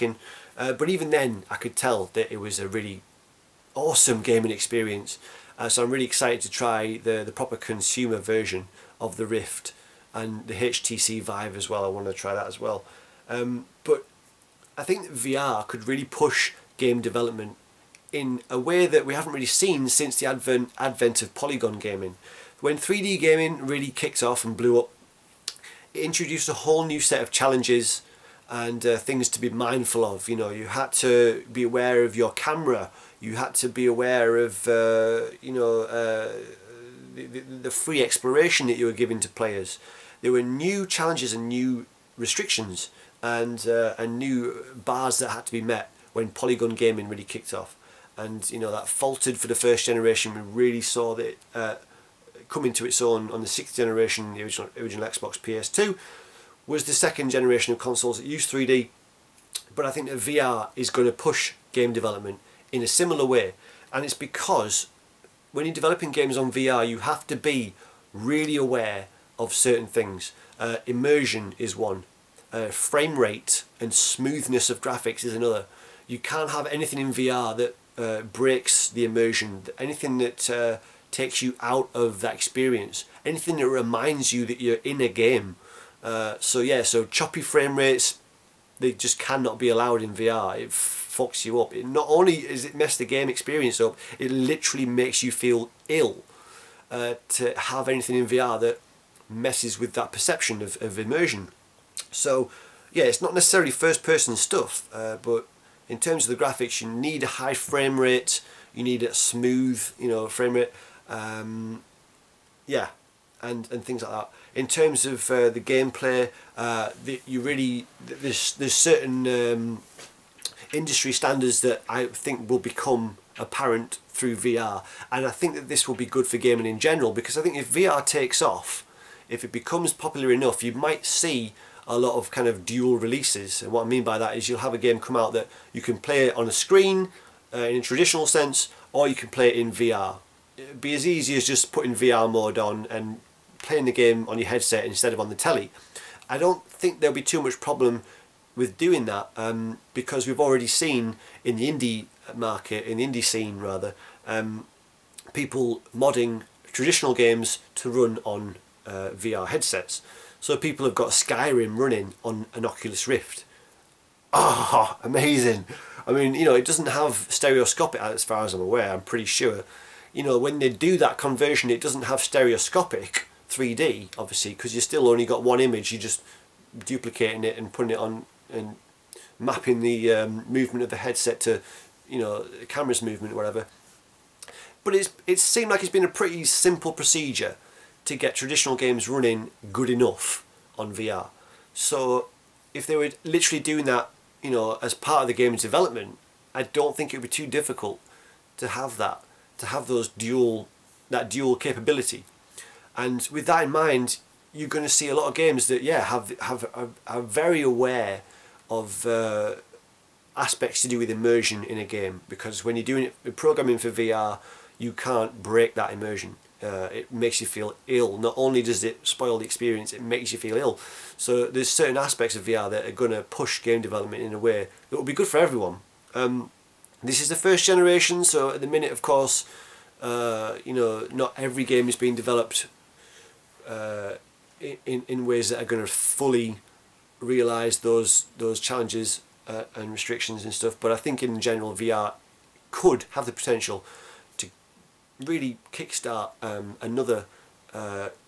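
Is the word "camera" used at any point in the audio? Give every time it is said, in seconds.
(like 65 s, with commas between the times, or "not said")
32 s, 182 s.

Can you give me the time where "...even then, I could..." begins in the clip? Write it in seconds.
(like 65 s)
0 s.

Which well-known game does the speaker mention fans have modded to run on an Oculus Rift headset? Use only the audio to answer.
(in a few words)
Skyrim.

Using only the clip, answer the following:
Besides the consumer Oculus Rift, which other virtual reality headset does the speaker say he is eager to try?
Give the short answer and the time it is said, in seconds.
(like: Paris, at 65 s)
HTC Vive, at 10 s.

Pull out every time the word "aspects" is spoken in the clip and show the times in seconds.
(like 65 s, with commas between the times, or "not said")
210 s, 221 s.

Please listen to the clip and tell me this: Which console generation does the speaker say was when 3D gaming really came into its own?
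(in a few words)
sixth.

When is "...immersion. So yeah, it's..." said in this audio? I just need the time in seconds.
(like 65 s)
100 s.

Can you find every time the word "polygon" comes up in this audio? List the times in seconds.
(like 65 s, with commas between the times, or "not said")
21 s, 46 s.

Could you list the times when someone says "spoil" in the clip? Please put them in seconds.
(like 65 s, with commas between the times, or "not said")
219 s.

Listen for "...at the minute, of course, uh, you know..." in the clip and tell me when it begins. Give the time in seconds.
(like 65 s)
228 s.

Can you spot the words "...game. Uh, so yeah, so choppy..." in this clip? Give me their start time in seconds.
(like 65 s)
85 s.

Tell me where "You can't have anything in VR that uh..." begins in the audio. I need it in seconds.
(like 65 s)
76 s.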